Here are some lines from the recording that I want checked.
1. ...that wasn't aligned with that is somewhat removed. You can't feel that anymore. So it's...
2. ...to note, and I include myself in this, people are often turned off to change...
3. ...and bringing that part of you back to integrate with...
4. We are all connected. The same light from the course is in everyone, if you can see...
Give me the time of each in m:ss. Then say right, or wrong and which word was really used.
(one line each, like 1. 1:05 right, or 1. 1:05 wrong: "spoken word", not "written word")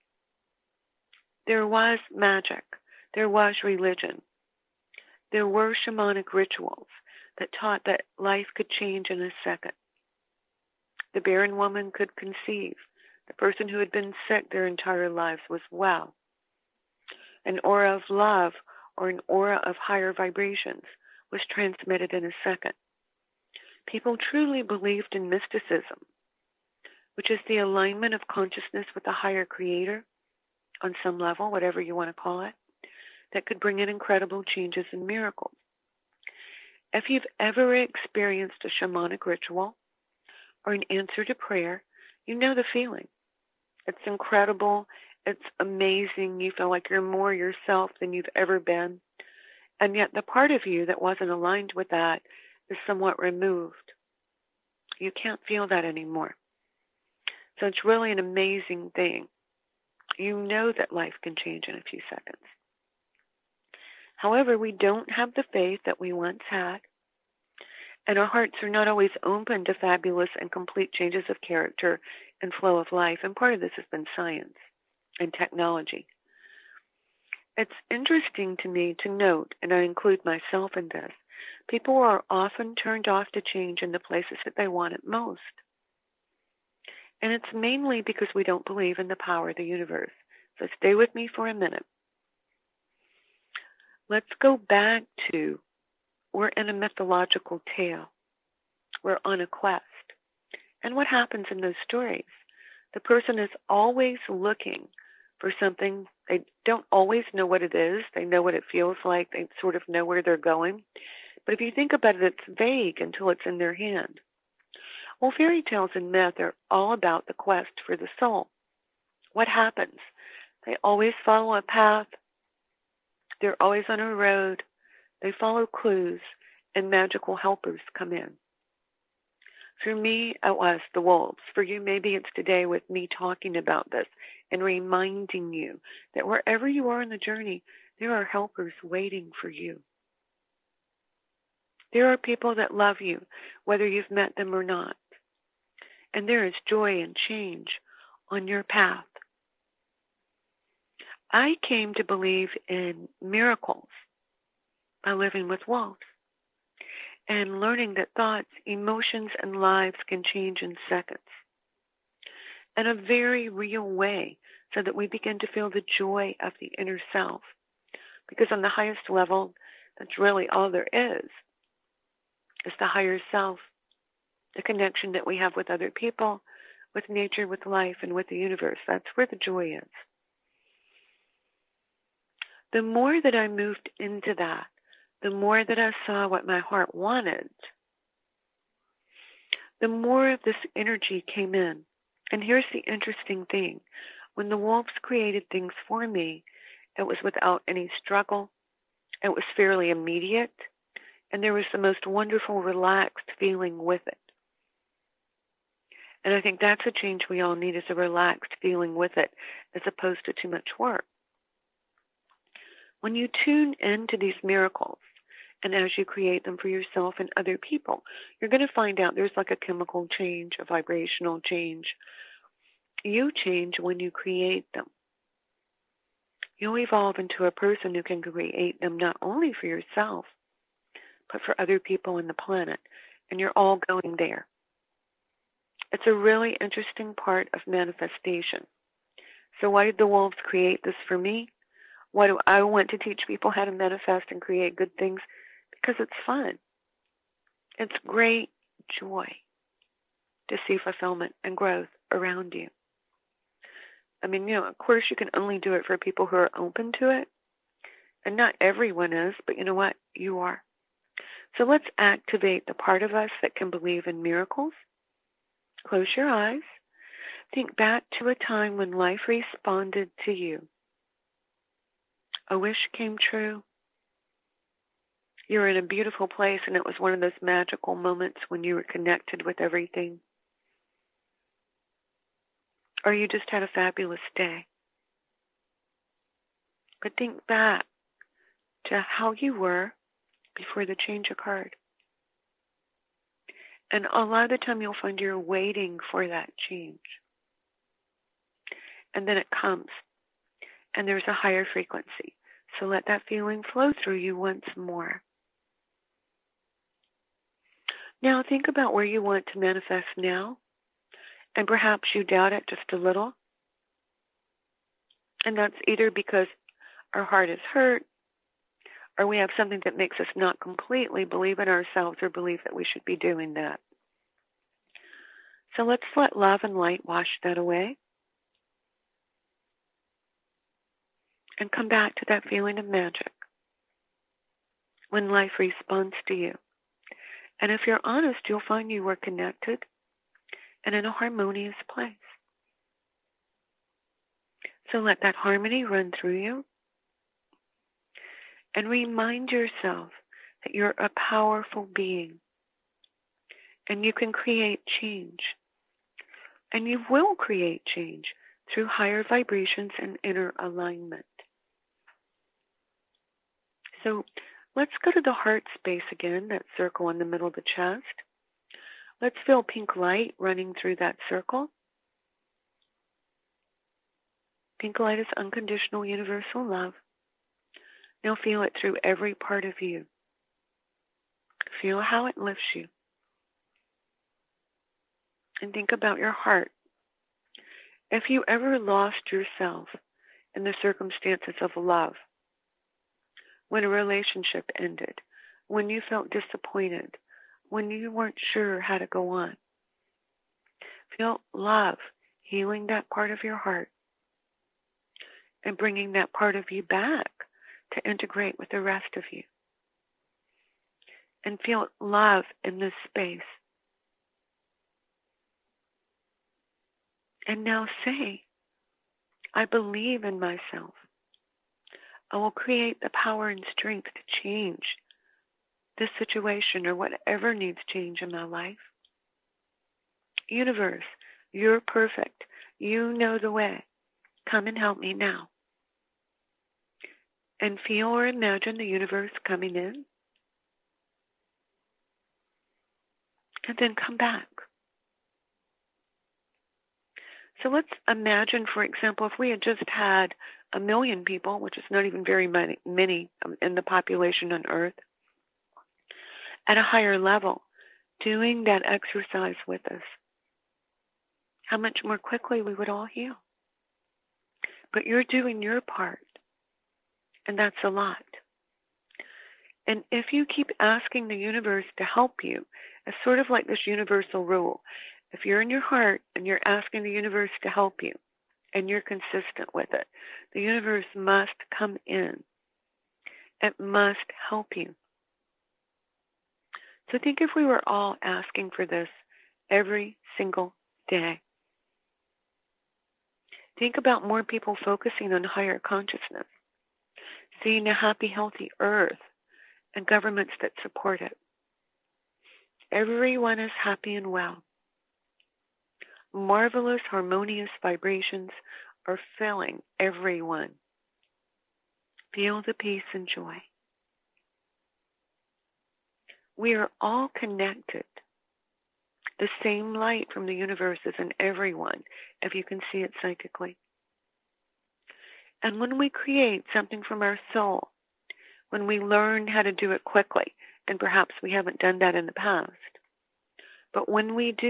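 1. 0:50 right
2. 1:19 right
3. 6:45 right
4. 8:36 wrong: "universe", not "course".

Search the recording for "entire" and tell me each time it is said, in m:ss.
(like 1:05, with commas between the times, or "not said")
0:14.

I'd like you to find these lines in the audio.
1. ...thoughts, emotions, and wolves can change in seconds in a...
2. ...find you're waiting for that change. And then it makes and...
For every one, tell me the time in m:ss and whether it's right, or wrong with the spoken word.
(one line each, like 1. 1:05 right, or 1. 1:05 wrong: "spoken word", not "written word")
1. 2:38 wrong: "lives", not "wolves"
2. 4:55 wrong: "comes", not "makes".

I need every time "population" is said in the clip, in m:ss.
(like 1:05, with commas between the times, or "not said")
7:33.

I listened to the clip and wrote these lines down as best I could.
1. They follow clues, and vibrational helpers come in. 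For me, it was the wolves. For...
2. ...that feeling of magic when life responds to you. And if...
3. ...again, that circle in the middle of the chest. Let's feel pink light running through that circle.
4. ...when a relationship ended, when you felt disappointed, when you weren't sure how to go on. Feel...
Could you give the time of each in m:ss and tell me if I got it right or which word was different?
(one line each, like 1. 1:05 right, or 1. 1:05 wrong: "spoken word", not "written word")
1. 2:05 wrong: "magical", not "vibrational"
2. 5:32 right
3. 6:06 right
4. 6:33 right.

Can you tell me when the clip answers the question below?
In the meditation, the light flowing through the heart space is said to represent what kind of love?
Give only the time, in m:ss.
6:15.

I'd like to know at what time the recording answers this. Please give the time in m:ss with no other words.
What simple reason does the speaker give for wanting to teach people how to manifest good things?
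4:05.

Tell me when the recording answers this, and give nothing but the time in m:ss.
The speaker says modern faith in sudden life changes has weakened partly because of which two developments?
1:14.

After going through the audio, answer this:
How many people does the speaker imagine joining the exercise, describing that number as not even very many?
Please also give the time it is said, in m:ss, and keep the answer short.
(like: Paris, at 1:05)
A million, at 7:30.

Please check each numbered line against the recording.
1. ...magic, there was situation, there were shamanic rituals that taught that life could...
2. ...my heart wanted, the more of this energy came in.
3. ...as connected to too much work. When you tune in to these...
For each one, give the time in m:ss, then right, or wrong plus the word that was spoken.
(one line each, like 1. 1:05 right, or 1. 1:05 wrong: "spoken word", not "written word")
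1. 0:02 wrong: "religion", not "situation"
2. 3:06 right
3. 3:29 wrong: "opposed", not "connected".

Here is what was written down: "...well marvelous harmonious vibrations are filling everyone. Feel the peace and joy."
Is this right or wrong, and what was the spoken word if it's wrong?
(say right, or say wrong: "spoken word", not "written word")
right.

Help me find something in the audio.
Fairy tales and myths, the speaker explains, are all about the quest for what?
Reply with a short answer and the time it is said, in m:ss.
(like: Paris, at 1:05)
The soul, at 1:57.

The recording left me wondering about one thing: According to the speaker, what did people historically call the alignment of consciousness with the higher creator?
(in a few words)
Mysticism.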